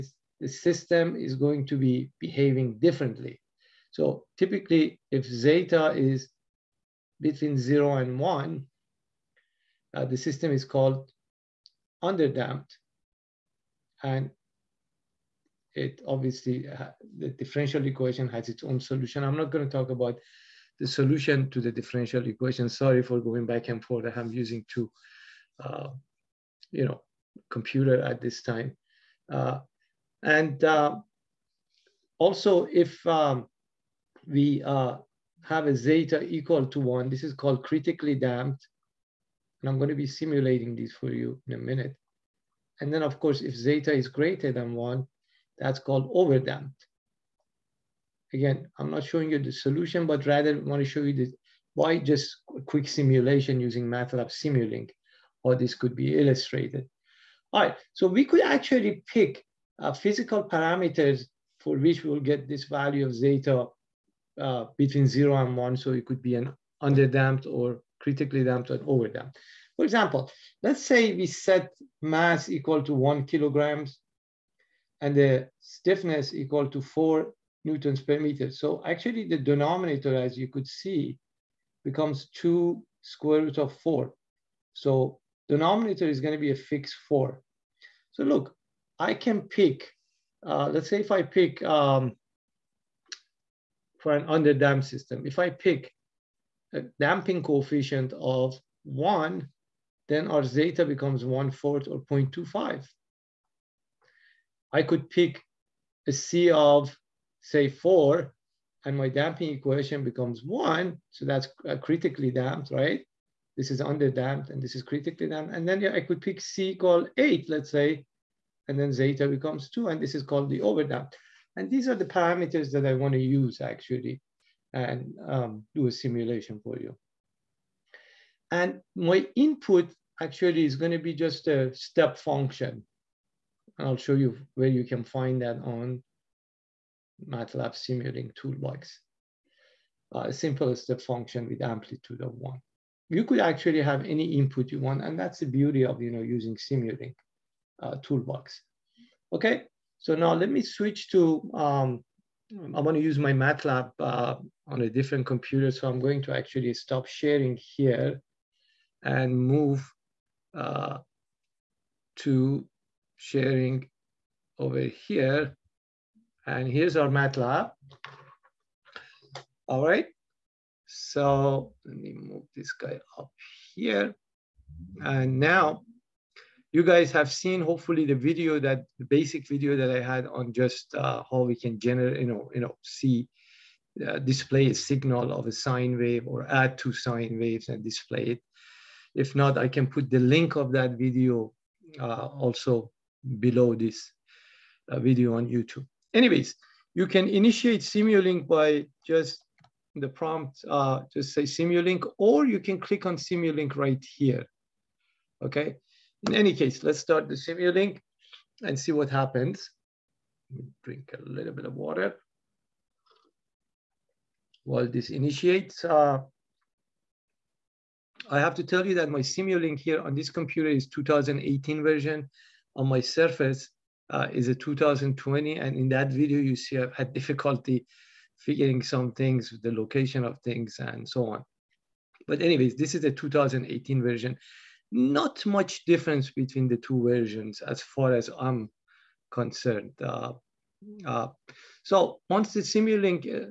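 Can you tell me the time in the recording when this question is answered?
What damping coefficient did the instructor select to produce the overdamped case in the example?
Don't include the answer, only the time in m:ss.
1:56.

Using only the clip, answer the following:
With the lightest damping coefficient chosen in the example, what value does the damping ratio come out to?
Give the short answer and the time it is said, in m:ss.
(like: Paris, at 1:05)
0.25, at 1:42.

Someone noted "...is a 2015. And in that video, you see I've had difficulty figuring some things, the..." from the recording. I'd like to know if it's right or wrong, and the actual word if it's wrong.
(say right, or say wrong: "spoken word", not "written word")
wrong: "2020", not "2015".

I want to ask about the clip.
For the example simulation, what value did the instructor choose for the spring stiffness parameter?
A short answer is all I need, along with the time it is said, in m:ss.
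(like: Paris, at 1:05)
4 newtons per meter, at 1:16.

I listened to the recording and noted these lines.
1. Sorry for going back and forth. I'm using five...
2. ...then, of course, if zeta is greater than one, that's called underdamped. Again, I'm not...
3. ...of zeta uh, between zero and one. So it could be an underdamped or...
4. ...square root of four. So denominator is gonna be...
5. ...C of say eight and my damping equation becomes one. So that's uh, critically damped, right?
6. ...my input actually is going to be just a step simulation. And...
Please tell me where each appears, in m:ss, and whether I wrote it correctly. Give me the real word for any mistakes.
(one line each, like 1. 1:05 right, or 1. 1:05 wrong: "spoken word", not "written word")
1. 0:22 wrong: "two", not "five"
2. 0:42 wrong: "overdamped", not "underdamped"
3. 1:03 right
4. 1:23 right
5. 1:46 wrong: "four", not "eight"
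6. 2:08 wrong: "function", not "simulation".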